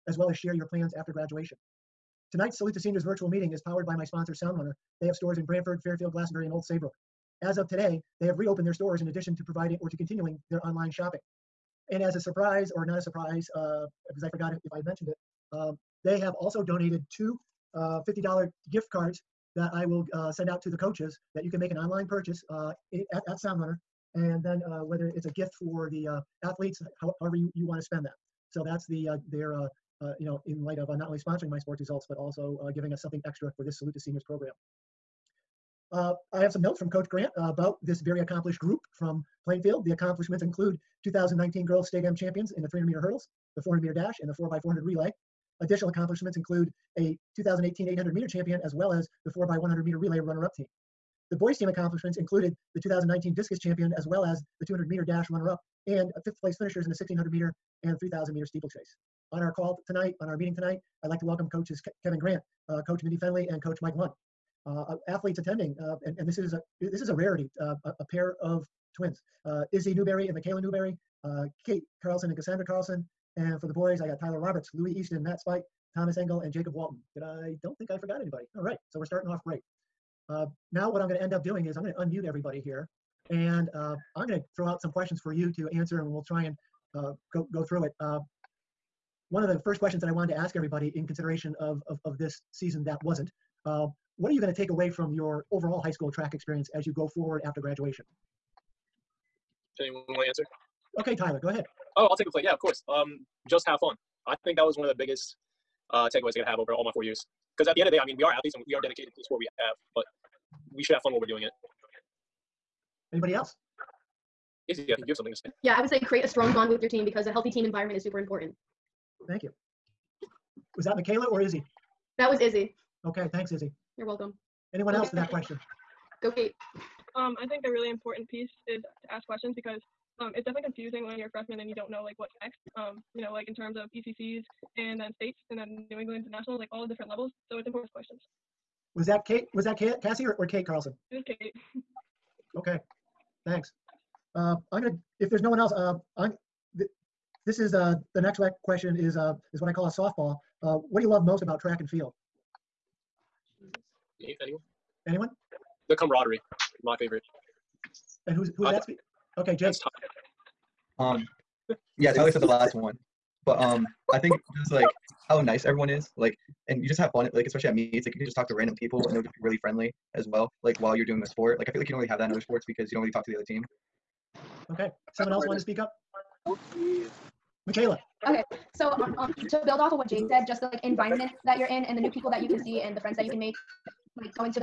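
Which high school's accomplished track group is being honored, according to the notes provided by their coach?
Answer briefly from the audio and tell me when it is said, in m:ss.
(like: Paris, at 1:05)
Plainfield, at 0:39.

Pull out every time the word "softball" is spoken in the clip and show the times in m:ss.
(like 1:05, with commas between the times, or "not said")
2:29.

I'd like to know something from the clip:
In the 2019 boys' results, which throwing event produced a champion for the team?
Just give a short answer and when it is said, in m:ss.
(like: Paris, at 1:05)
Discus, at 0:53.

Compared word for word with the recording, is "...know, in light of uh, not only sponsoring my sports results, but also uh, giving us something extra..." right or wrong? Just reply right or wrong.
right.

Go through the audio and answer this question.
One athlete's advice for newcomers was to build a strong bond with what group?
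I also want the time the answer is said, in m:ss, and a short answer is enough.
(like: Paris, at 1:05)
Your team, at 1:56.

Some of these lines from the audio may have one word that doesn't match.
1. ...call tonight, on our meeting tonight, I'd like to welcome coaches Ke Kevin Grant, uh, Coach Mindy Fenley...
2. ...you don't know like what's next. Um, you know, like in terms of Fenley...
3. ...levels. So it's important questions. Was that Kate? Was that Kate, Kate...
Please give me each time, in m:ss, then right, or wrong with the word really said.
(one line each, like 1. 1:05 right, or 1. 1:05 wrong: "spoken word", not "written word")
1. 0:59 right
2. 2:11 wrong: "ECCs", not "Fenley"
3. 2:17 wrong: "Cassie", not "Kate".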